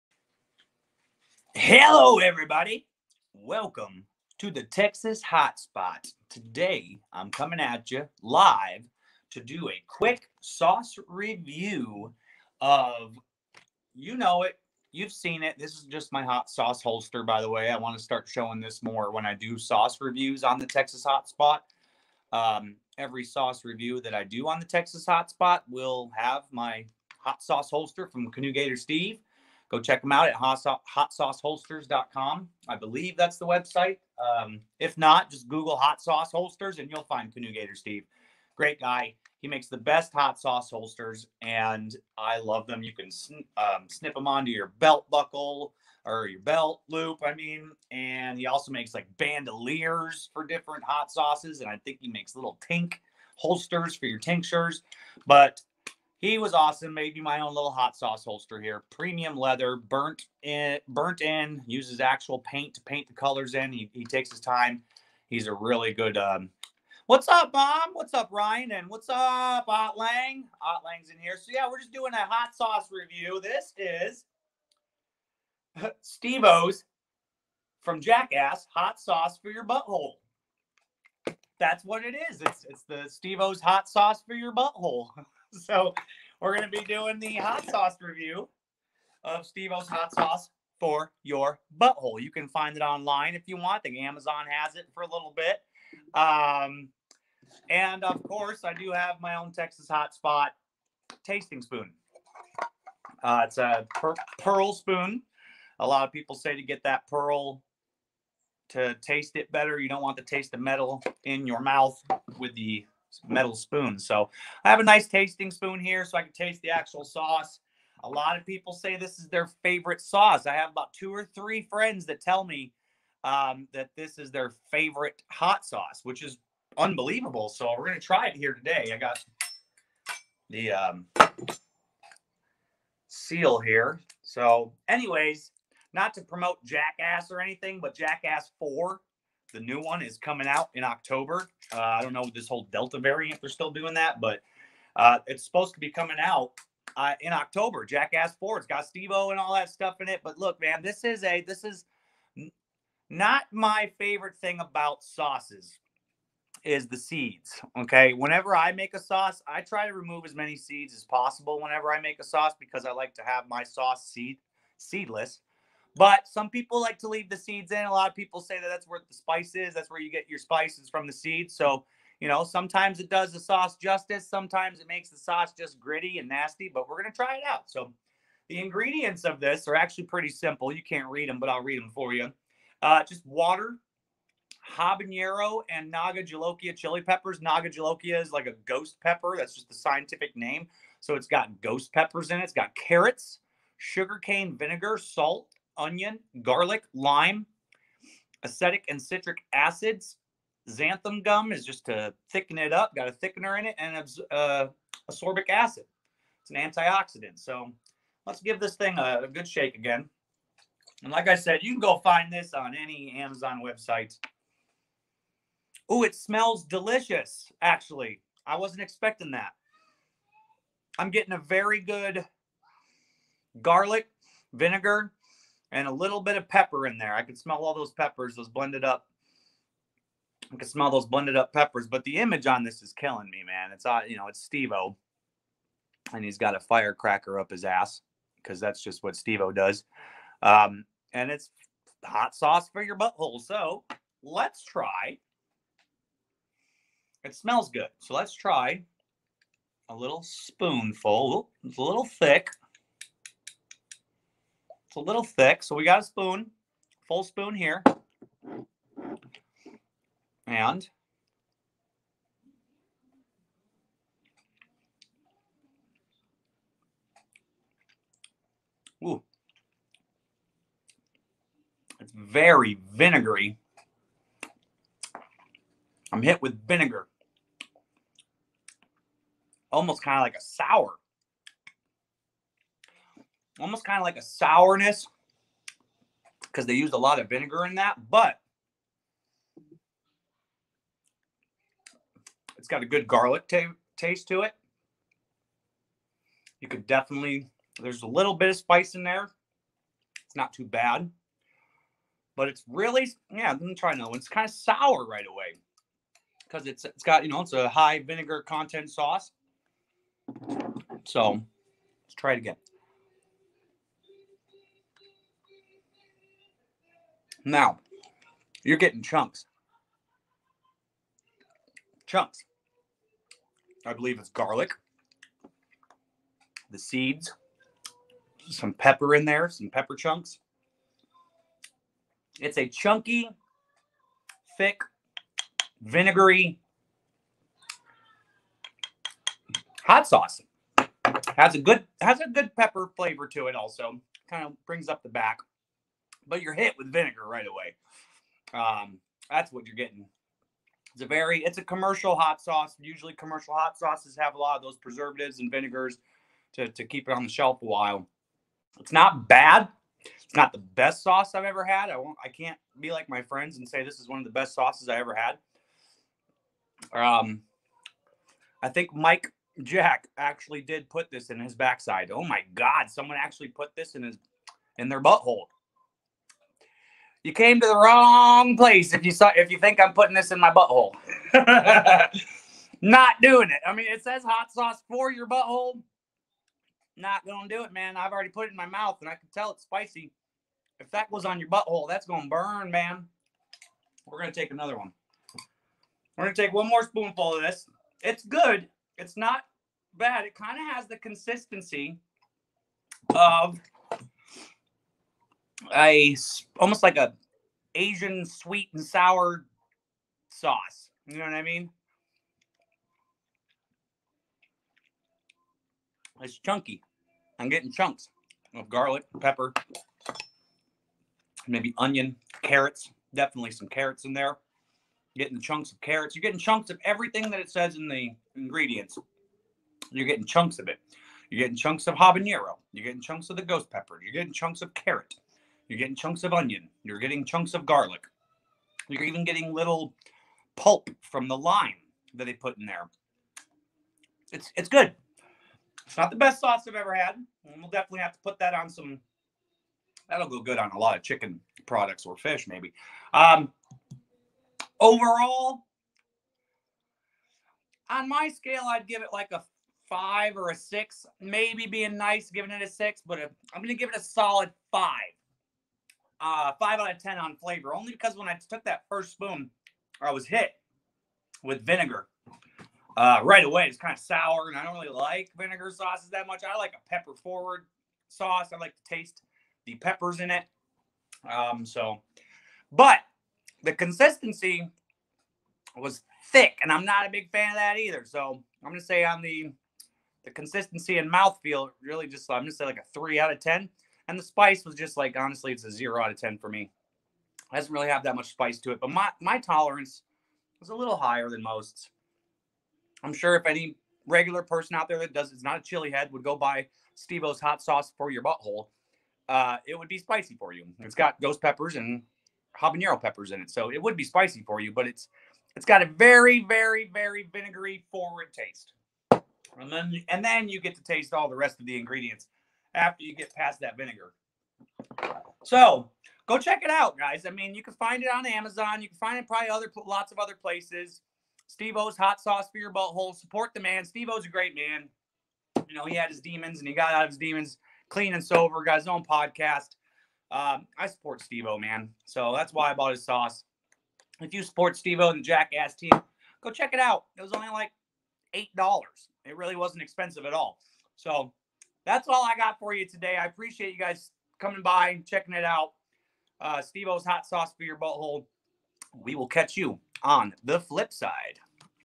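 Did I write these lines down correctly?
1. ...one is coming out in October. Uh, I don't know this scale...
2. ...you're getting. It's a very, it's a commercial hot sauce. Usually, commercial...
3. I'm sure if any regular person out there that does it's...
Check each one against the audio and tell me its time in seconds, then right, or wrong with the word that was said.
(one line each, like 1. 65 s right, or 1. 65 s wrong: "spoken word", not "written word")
1. 139 s wrong: "whole", not "scale"
2. 349 s right
3. 503 s right.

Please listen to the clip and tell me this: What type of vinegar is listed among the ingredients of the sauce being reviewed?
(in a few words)
sugarcane vinegar.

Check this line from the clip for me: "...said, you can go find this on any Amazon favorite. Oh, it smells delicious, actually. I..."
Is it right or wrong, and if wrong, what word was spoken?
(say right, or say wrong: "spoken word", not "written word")
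wrong: "website", not "favorite".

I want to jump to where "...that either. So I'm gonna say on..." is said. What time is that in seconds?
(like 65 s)
487 s.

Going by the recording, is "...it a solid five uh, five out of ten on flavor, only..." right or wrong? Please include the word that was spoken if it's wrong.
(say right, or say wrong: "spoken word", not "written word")
right.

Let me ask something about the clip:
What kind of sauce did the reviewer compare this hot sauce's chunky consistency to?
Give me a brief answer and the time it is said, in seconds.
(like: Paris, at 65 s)
Asian sweet and sour sauce, at 407 s.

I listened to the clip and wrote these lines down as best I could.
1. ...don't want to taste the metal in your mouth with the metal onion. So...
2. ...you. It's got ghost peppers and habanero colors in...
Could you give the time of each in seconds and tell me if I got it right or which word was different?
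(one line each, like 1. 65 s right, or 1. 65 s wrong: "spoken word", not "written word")
1. 109 s wrong: "spoon", not "onion"
2. 510 s wrong: "peppers", not "colors".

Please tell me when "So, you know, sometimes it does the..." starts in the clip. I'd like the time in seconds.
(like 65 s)
171 s.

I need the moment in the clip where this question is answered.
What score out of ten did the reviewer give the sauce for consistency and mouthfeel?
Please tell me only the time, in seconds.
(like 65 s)
492 s.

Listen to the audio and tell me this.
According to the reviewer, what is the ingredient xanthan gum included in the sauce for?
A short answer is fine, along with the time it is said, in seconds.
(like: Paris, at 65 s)
to thicken it, at 201 s.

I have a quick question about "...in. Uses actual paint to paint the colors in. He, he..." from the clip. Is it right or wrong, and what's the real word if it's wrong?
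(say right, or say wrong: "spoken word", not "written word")
right.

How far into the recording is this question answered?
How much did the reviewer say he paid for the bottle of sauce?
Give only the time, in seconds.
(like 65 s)
548 s.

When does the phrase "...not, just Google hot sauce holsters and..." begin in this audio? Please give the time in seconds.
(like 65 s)
34 s.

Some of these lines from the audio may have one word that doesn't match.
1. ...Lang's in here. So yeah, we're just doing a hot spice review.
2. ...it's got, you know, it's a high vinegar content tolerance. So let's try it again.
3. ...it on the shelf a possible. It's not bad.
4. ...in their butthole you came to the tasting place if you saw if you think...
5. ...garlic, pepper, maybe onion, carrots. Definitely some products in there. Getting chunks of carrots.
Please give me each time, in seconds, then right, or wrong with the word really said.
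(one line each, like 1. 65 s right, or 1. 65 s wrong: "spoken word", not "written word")
1. 70 s wrong: "sauce", not "spice"
2. 306 s wrong: "sauce", not "tolerance"
3. 357 s wrong: "while", not "possible"
4. 374 s wrong: "wrong", not "tasting"
5. 418 s wrong: "carrots", not "products".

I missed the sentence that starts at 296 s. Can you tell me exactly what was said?
You could definitely, there's a little bit of spice in there.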